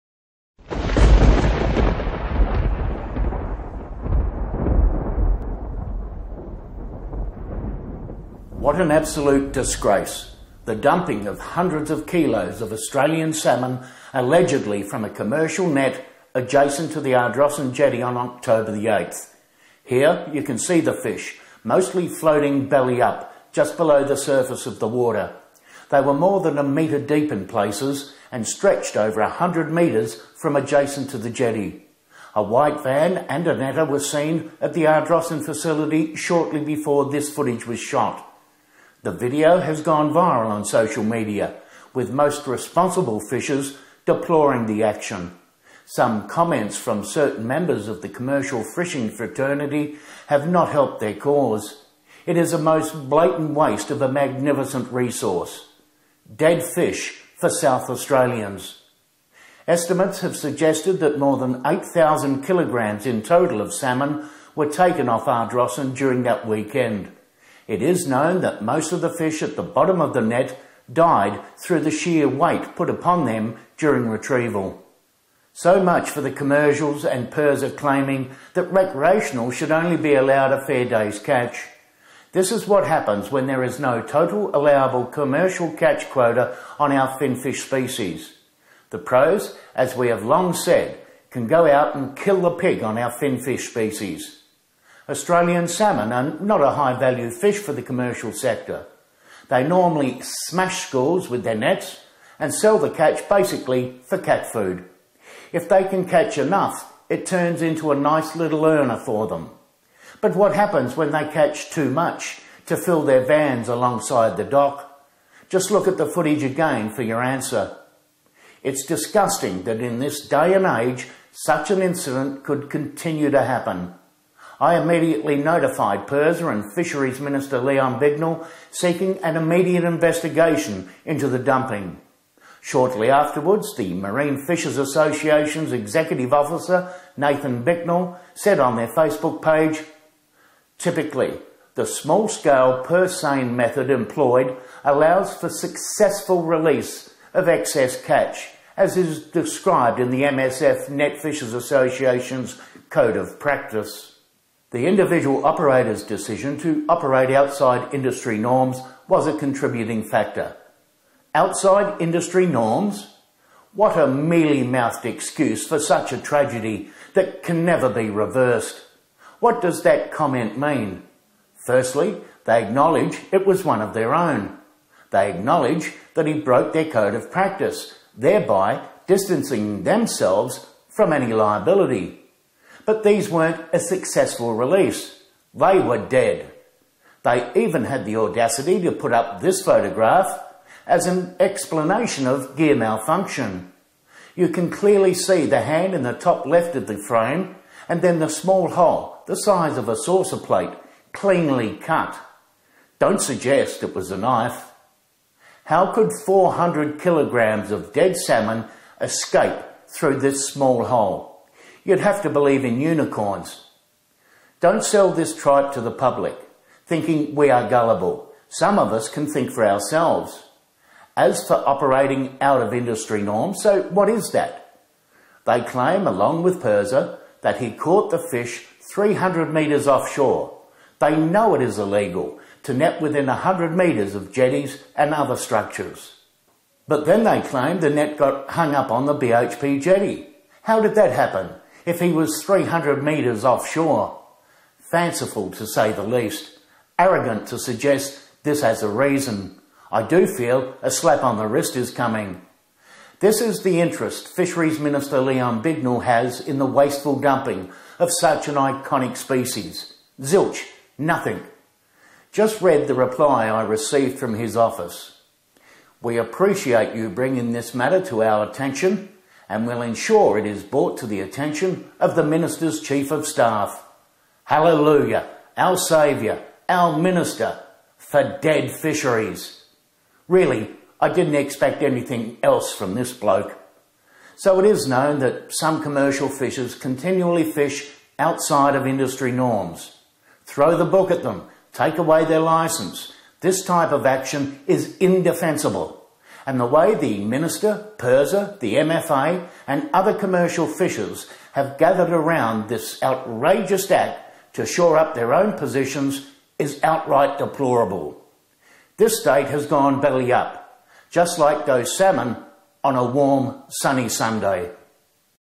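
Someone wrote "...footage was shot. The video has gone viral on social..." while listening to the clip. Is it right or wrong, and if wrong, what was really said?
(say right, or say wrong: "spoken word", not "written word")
right.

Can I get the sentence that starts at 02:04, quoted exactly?
I immediately notified PIRSA and Fisheries Minister Leon Bignell, seeking an immediate investigation into the dumping.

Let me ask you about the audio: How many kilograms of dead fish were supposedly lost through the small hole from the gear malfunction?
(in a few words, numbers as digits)
400 kilograms.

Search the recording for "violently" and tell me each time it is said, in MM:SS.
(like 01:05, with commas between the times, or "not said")
not said.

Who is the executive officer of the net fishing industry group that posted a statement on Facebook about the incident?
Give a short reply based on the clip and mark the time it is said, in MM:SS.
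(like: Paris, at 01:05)
Nathan Bicknell, at 02:17.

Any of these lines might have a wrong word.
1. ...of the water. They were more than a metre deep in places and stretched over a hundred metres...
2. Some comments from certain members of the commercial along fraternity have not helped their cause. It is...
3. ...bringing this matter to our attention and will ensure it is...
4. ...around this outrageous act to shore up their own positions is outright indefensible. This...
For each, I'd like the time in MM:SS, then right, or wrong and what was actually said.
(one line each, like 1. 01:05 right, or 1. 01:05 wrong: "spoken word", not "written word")
1. 00:24 right
2. 00:45 wrong: "fishing", not "along"
3. 04:27 right
4. 05:02 wrong: "deplorable", not "indefensible".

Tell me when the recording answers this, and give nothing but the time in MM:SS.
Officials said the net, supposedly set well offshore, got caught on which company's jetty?
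03:59.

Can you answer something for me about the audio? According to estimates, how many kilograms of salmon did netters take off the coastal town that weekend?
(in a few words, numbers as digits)
8,000 kilograms.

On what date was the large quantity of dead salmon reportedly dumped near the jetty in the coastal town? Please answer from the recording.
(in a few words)
October 8.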